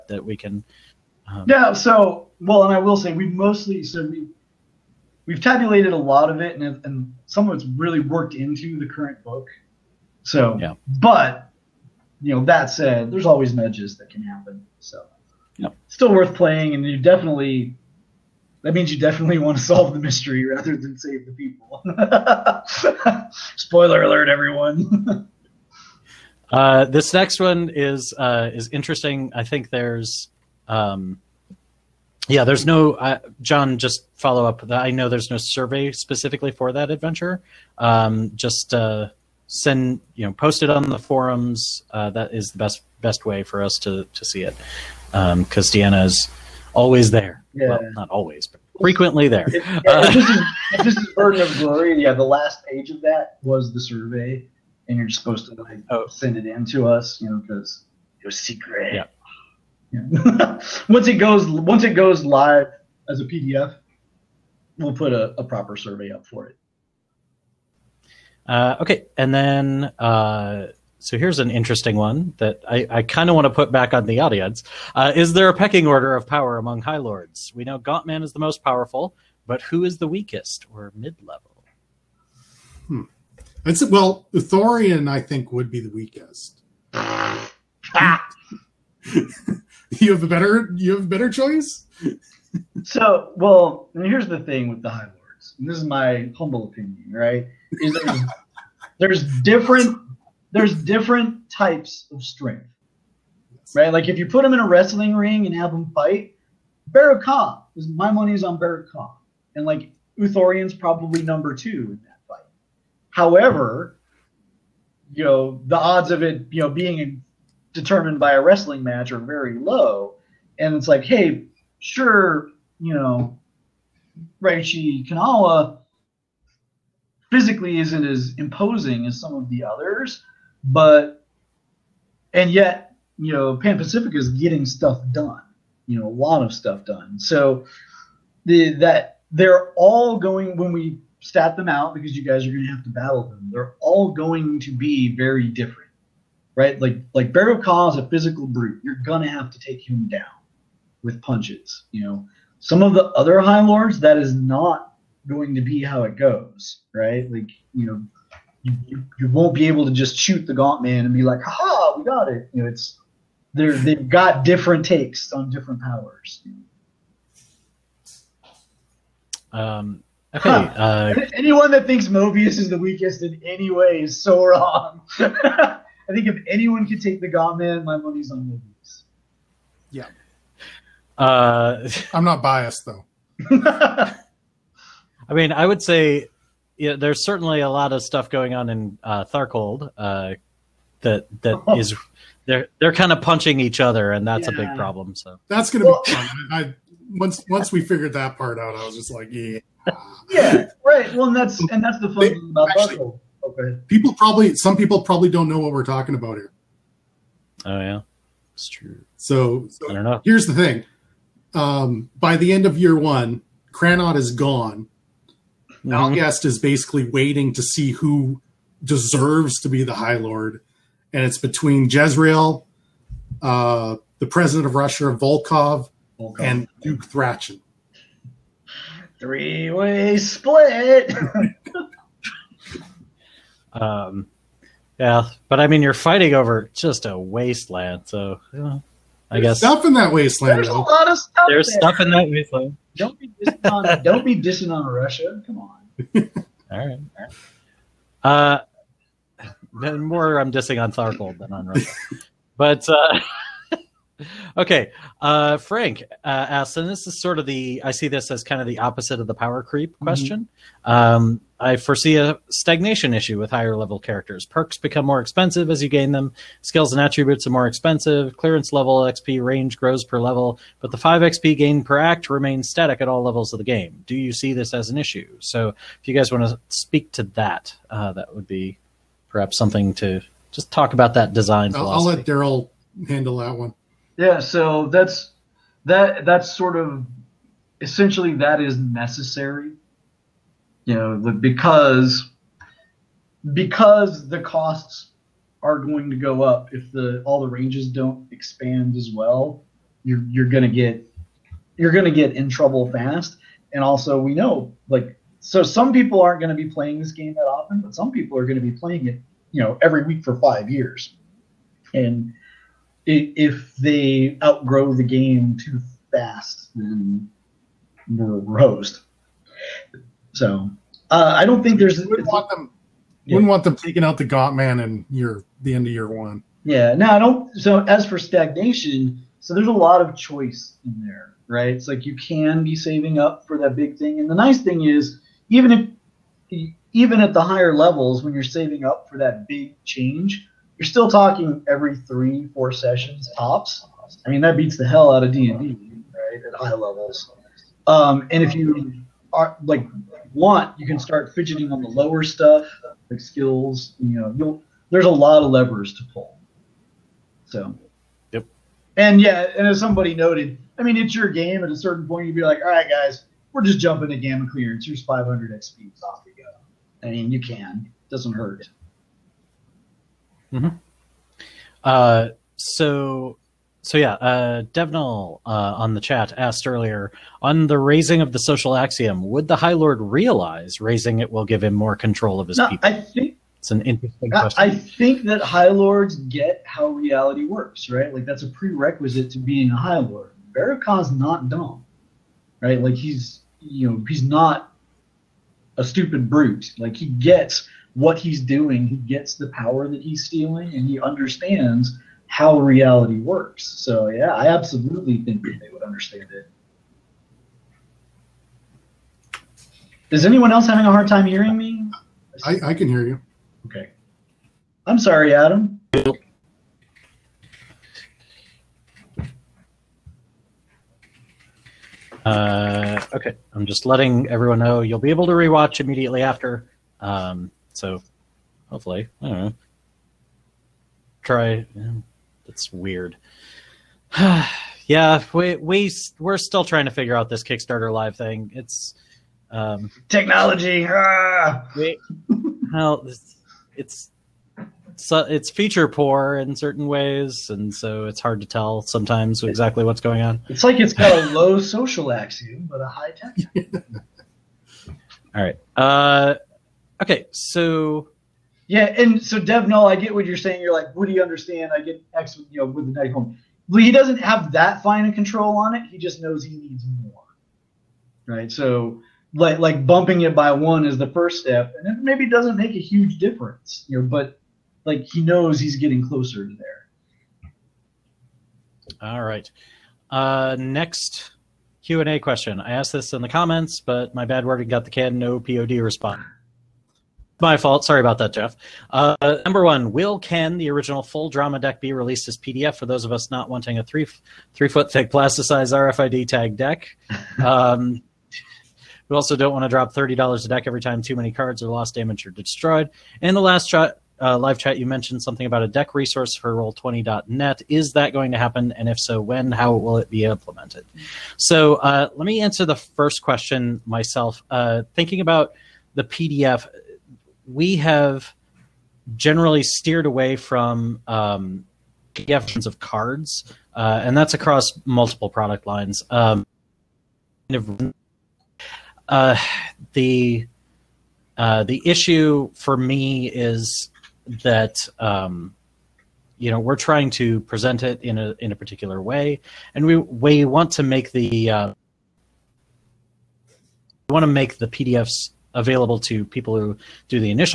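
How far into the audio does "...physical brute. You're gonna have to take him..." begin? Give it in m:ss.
2:28.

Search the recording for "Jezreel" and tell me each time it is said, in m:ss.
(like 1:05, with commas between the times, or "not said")
3:41.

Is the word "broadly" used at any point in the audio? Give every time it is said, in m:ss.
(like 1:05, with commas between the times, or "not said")
not said.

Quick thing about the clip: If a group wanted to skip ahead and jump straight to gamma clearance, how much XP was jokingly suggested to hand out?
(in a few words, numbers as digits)
500 XP.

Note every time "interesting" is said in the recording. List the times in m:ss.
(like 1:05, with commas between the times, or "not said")
0:28, 1:11, 6:23.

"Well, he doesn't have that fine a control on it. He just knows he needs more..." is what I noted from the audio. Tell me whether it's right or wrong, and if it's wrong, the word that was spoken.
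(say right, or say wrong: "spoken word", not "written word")
right.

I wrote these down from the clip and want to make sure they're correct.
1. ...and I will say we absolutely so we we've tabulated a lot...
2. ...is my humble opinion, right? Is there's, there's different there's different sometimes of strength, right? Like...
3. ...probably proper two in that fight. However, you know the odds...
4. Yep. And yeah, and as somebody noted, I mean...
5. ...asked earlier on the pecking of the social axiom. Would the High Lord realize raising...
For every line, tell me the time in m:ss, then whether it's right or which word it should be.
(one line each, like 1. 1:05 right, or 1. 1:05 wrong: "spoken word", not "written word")
1. 0:02 wrong: "mostly", not "absolutely"
2. 1:35 wrong: "types", not "sometimes"
3. 1:50 wrong: "number", not "proper"
4. 5:58 right
5. 6:16 wrong: "raising", not "pecking".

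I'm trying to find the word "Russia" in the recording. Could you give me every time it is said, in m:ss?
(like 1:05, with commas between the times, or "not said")
3:44, 4:04, 4:11.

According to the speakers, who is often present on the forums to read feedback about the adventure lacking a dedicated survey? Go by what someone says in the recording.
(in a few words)
Deanna.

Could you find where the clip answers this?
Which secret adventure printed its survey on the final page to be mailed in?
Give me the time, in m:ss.
0:51.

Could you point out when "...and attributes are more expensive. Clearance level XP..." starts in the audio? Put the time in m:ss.
4:26.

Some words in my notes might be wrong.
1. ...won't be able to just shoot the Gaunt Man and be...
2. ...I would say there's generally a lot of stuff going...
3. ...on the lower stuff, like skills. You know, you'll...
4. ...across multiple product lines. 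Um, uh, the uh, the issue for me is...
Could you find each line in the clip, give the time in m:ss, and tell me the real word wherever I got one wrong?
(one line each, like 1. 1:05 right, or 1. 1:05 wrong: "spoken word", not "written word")
1. 2:39 right
2. 3:05 wrong: "certainly", not "generally"
3. 5:51 right
4. 8:44 right.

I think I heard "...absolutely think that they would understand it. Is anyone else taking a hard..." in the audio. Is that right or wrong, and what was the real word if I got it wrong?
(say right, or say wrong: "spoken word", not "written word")
wrong: "having", not "taking".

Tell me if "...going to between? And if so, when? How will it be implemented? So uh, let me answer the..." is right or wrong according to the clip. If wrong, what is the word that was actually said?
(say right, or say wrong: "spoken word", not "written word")
wrong: "happen", not "between".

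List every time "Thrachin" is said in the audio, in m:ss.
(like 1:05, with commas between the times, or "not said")
3:47.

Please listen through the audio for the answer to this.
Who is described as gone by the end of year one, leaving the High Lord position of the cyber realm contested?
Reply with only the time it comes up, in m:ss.
3:33.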